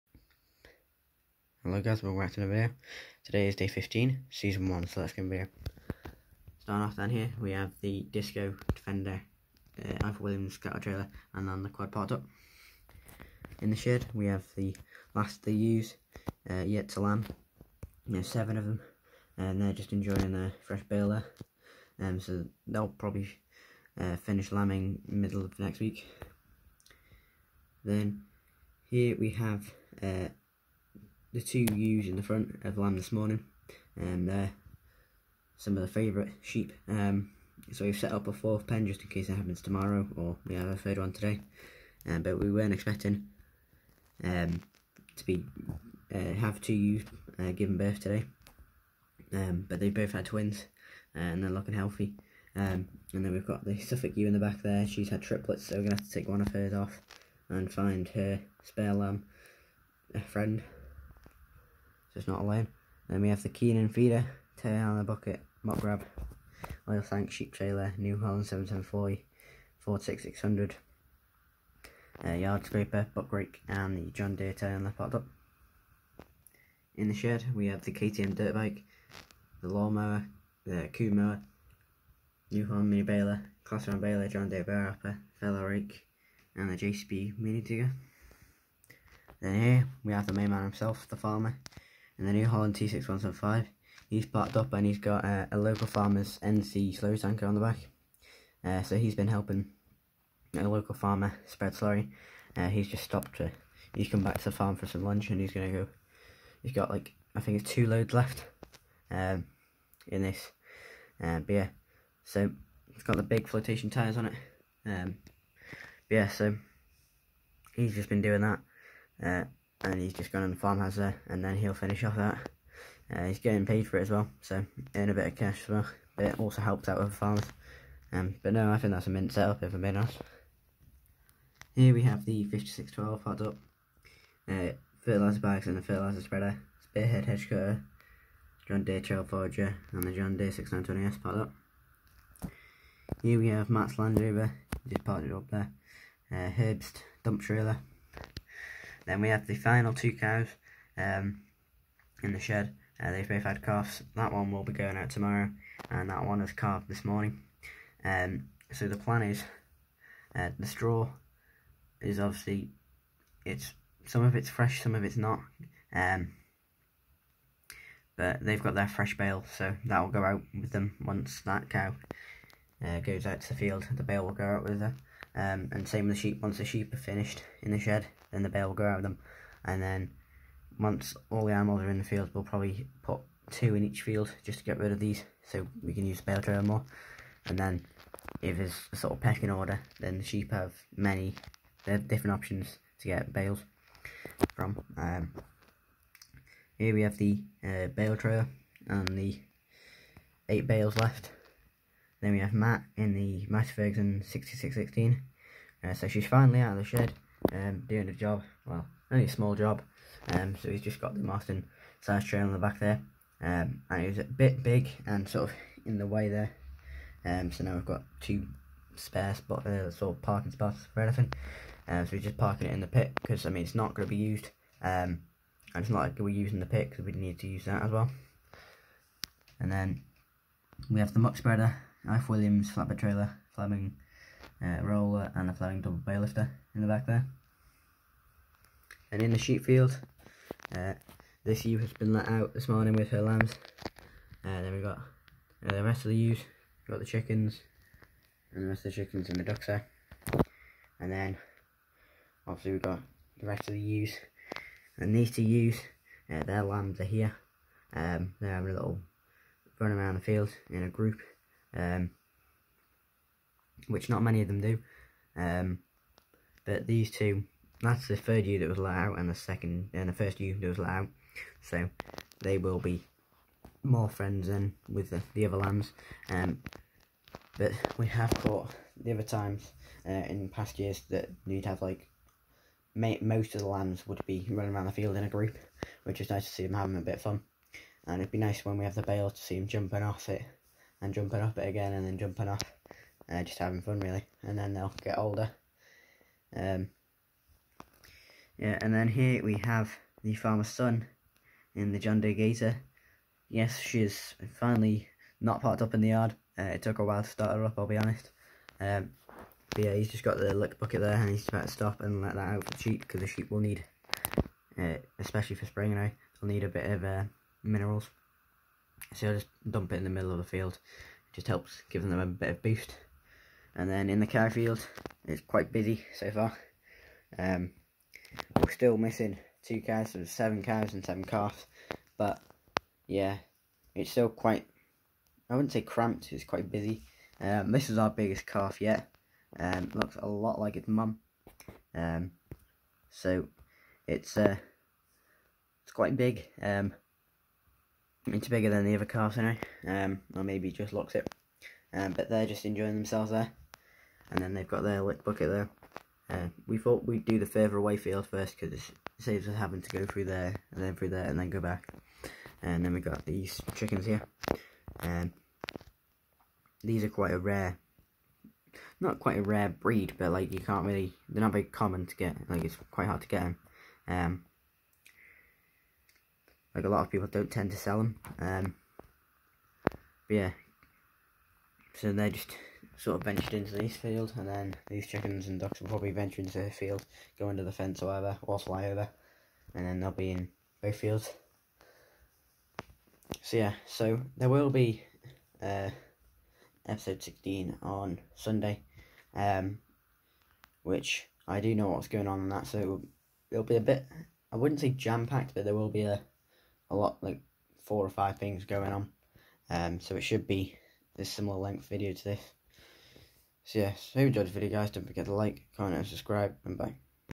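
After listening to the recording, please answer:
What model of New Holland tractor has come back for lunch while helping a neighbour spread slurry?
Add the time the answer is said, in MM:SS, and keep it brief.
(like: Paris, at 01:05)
T6175, at 01:32.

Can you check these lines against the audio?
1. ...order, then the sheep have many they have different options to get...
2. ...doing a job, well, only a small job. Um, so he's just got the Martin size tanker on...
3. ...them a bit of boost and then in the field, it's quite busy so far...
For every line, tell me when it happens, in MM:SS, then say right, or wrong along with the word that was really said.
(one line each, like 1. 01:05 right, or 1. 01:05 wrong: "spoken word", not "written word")
1. 03:09 right
2. 03:27 wrong: "trailer", not "tanker"
3. 05:22 right.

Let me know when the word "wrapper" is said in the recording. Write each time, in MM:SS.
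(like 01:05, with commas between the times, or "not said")
01:24.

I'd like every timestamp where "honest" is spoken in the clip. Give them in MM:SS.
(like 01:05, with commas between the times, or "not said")
02:09, 05:07.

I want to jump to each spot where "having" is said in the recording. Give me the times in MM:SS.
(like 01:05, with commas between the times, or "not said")
04:18, 04:46, 04:53, 05:59.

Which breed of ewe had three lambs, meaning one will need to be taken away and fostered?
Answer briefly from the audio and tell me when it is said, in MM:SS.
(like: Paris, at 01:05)
Suffolk, at 00:53.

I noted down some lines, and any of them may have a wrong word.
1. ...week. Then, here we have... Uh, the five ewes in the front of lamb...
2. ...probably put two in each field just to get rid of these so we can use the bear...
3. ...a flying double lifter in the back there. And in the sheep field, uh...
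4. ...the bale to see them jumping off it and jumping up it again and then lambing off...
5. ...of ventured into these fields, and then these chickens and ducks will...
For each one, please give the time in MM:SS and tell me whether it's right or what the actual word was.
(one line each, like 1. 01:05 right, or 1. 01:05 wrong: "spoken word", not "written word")
1. 00:25 wrong: "two", not "five"
2. 03:02 right
3. 03:55 right
4. 04:48 wrong: "jumping", not "lambing"
5. 06:23 right.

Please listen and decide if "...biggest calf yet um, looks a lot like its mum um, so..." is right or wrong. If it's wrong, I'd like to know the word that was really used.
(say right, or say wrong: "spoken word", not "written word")
right.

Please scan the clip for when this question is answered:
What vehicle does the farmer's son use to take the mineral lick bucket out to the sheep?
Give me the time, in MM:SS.
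05:01.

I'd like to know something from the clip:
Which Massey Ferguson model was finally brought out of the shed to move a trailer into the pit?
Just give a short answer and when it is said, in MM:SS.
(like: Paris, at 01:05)
6616, at 03:23.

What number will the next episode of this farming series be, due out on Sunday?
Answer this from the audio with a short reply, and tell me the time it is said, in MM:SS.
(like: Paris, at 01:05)
16, at 06:36.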